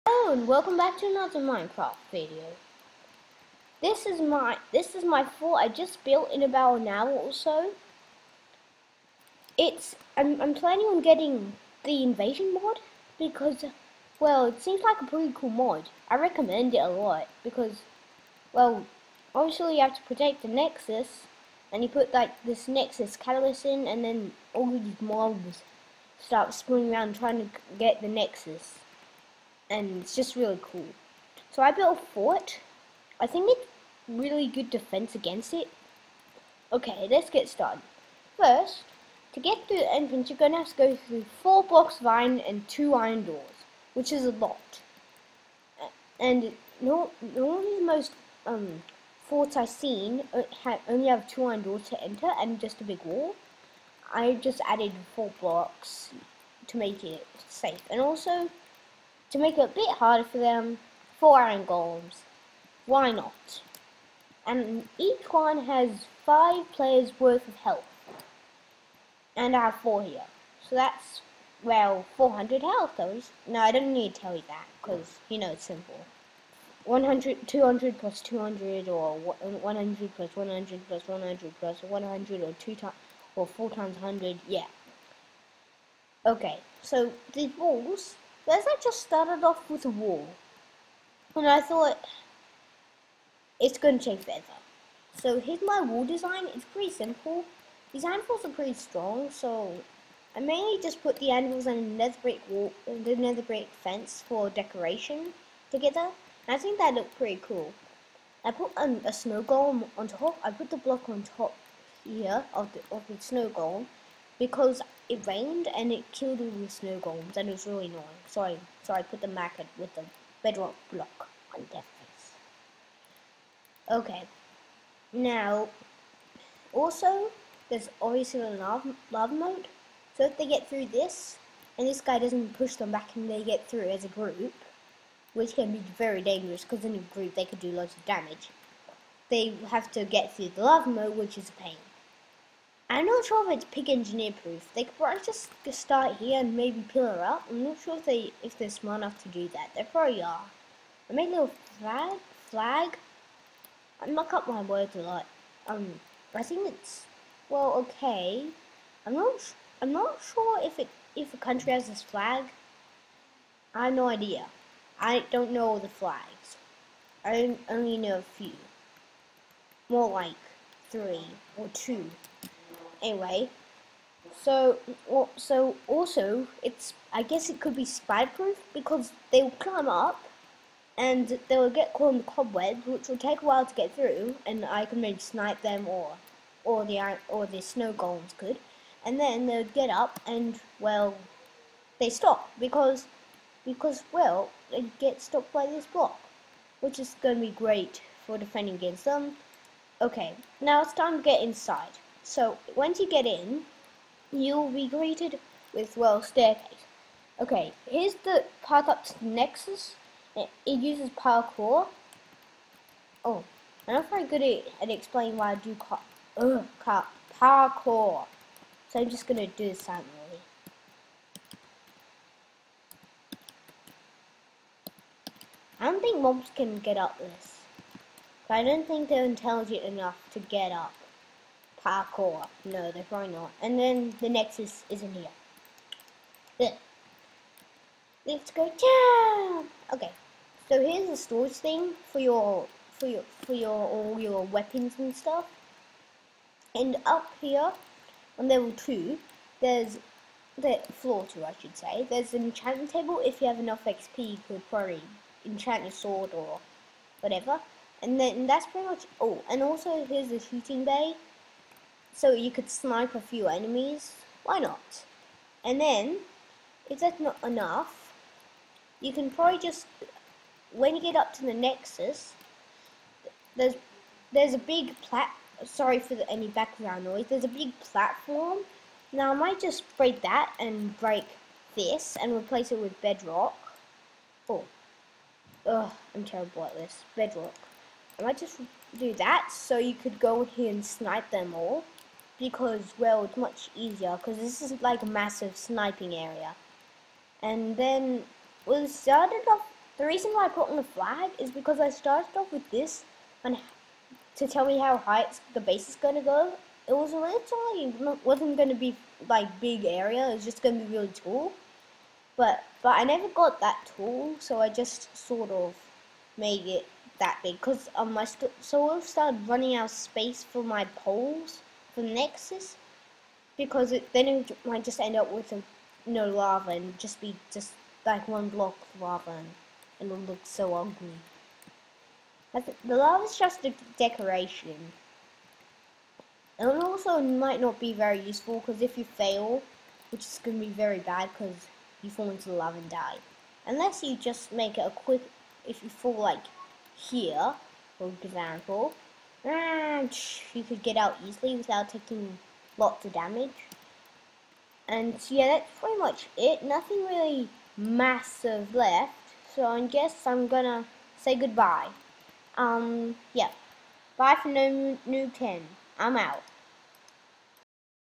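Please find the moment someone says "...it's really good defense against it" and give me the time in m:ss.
0:33.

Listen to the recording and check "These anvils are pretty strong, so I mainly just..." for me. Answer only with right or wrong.
right.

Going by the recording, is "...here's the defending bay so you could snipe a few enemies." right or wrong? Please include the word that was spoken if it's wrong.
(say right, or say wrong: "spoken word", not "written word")
wrong: "shooting", not "defending".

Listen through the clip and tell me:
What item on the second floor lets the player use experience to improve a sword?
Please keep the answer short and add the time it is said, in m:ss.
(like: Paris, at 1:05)
Enchantment table, at 4:12.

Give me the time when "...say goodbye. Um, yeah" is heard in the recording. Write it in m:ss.
6:01.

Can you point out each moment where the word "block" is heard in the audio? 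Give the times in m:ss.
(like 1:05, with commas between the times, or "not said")
0:41, 0:55, 1:50, 2:00, 3:15, 5:28.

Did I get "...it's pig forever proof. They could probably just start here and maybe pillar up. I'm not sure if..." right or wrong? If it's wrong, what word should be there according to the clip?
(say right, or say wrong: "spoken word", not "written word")
wrong: "engineer", not "forever".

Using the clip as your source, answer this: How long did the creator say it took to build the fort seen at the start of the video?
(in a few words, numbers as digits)
About an hour.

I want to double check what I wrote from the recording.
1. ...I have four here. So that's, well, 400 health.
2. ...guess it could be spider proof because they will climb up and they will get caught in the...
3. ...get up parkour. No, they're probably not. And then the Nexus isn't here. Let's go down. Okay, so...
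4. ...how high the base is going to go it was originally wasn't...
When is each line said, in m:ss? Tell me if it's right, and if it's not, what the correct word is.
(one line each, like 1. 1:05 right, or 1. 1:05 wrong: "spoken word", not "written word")
1. 1:09 right
2. 2:57 right
3. 3:50 right
4. 5:04 right.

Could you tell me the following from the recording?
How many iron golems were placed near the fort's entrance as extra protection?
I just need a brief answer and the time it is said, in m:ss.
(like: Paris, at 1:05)
4, at 1:01.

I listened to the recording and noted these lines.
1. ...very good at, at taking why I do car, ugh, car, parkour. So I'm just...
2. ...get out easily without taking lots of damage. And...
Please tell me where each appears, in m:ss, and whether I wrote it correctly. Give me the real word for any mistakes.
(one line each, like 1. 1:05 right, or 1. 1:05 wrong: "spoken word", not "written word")
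1. 3:34 wrong: "explaining", not "taking"
2. 5:50 right.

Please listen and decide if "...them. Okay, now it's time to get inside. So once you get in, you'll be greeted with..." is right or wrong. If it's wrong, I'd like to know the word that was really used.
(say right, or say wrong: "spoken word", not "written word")
right.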